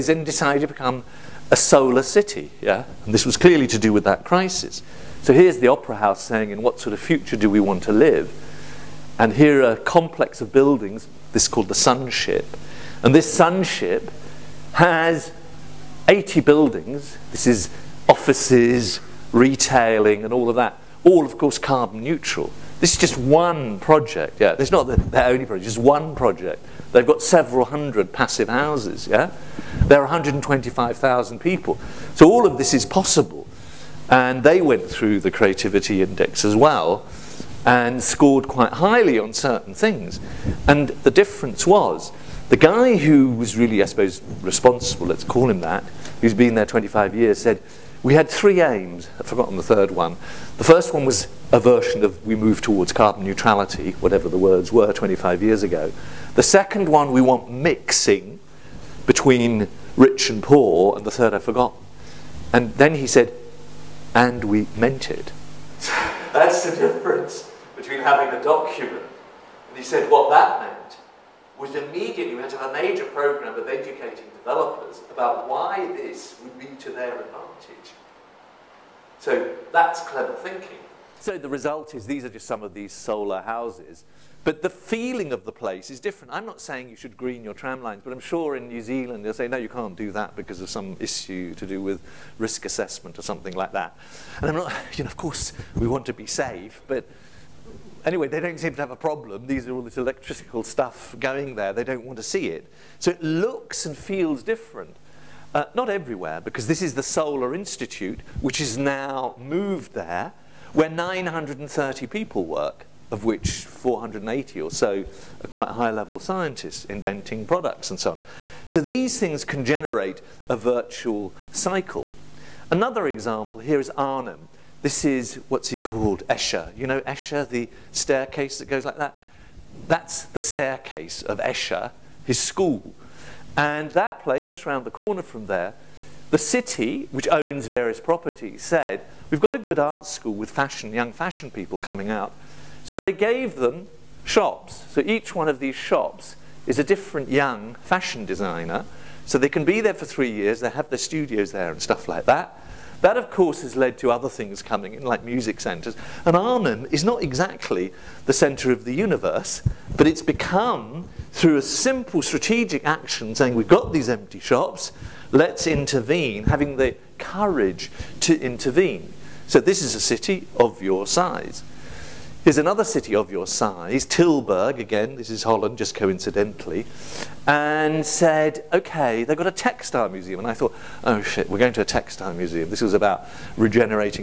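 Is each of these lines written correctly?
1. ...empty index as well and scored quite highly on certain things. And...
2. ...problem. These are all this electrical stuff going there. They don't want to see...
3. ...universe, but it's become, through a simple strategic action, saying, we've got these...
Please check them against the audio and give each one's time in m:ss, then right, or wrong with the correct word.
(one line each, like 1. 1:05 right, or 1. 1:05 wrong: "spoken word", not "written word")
1. 0:35 wrong: "creativity", not "empty"
2. 1:38 right
3. 2:38 right.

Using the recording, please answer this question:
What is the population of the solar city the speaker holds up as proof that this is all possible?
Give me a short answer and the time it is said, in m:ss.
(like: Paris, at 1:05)
125,000, at 0:30.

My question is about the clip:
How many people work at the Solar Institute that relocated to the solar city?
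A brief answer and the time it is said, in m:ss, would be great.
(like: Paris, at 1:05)
930, at 1:50.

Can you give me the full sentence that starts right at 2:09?
That's the staircase of Escher, his school.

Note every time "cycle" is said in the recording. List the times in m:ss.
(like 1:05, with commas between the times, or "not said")
2:01.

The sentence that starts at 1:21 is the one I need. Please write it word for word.
So the result is these are just some of these solar houses.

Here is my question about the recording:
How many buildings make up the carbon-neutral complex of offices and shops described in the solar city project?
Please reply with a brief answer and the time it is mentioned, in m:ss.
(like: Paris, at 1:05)
80, at 0:16.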